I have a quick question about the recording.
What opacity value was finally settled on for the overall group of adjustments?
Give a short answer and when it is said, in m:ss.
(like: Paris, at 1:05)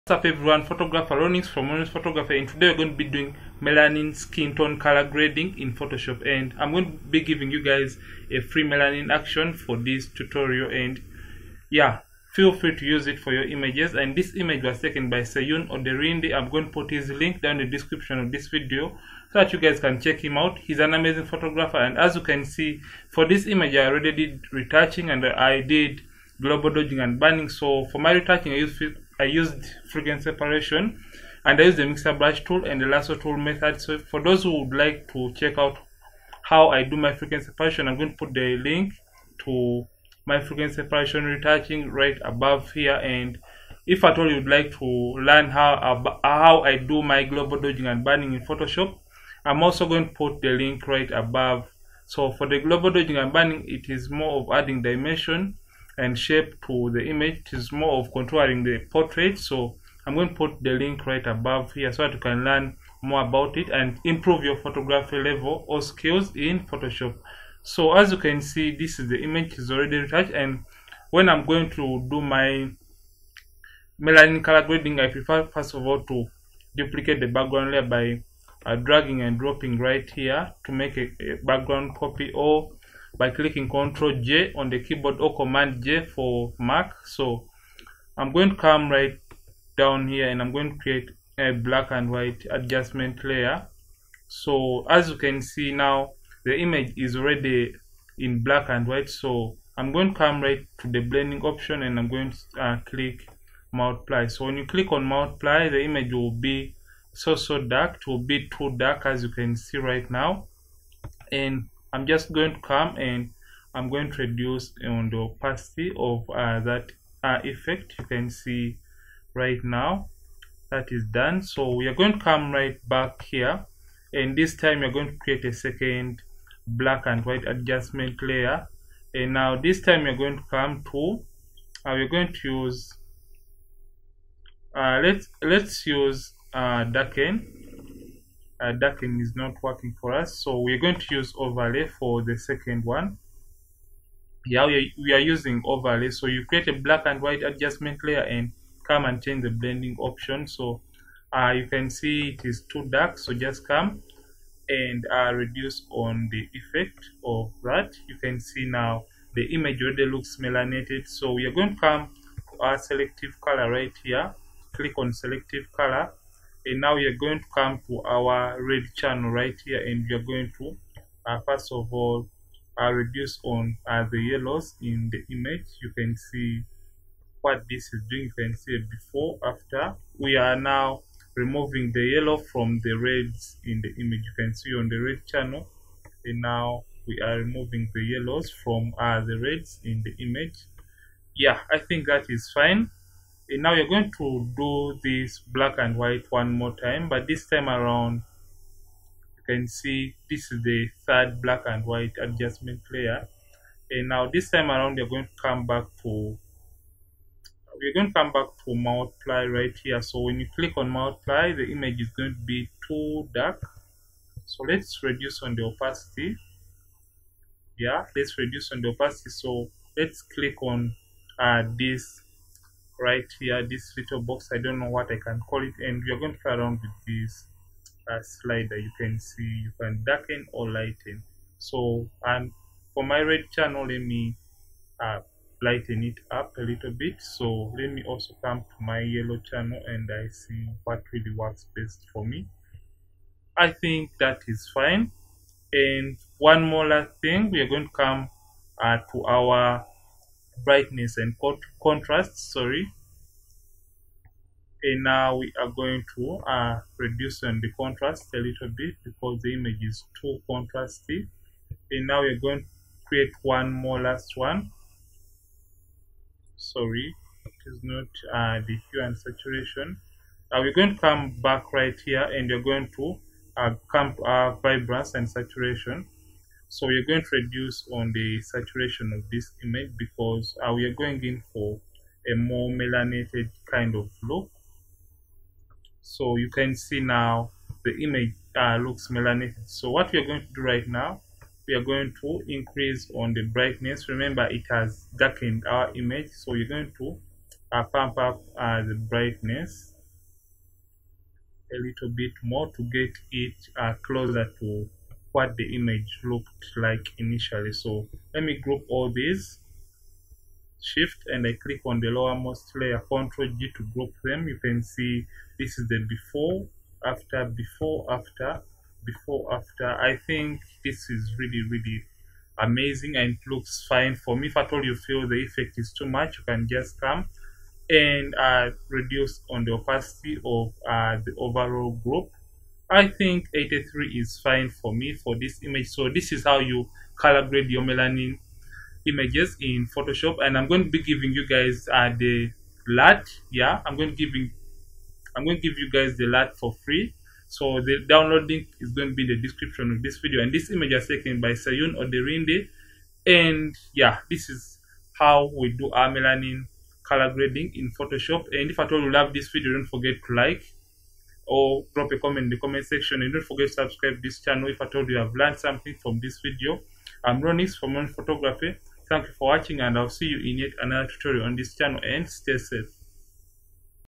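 83, at 5:33.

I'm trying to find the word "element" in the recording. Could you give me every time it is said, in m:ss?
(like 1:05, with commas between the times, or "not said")
not said.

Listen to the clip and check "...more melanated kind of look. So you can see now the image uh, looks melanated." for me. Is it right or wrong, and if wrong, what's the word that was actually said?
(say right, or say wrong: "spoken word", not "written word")
right.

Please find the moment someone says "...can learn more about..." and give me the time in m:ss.
1:02.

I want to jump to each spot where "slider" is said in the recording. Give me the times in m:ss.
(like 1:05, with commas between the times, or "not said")
3:48.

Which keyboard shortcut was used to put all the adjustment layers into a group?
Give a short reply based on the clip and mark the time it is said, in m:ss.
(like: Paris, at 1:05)
Control G, at 5:13.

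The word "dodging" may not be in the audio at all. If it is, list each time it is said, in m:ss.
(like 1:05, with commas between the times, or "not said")
0:26, 0:47, 0:52.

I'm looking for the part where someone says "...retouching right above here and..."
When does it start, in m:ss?
0:41.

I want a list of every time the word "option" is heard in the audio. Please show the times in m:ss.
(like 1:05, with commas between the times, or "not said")
1:41, 2:29.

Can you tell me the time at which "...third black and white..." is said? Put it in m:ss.
3:21.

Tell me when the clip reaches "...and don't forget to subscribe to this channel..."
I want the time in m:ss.
6:03.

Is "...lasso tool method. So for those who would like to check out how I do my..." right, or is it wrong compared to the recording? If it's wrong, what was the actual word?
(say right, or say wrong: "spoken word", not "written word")
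right.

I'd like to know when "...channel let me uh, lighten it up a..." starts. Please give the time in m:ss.
3:53.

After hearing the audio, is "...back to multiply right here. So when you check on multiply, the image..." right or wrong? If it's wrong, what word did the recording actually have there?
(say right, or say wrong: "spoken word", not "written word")
wrong: "click", not "check".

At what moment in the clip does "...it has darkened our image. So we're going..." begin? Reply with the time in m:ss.
4:54.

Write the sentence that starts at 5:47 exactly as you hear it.
So the download link is going to be the description of this video.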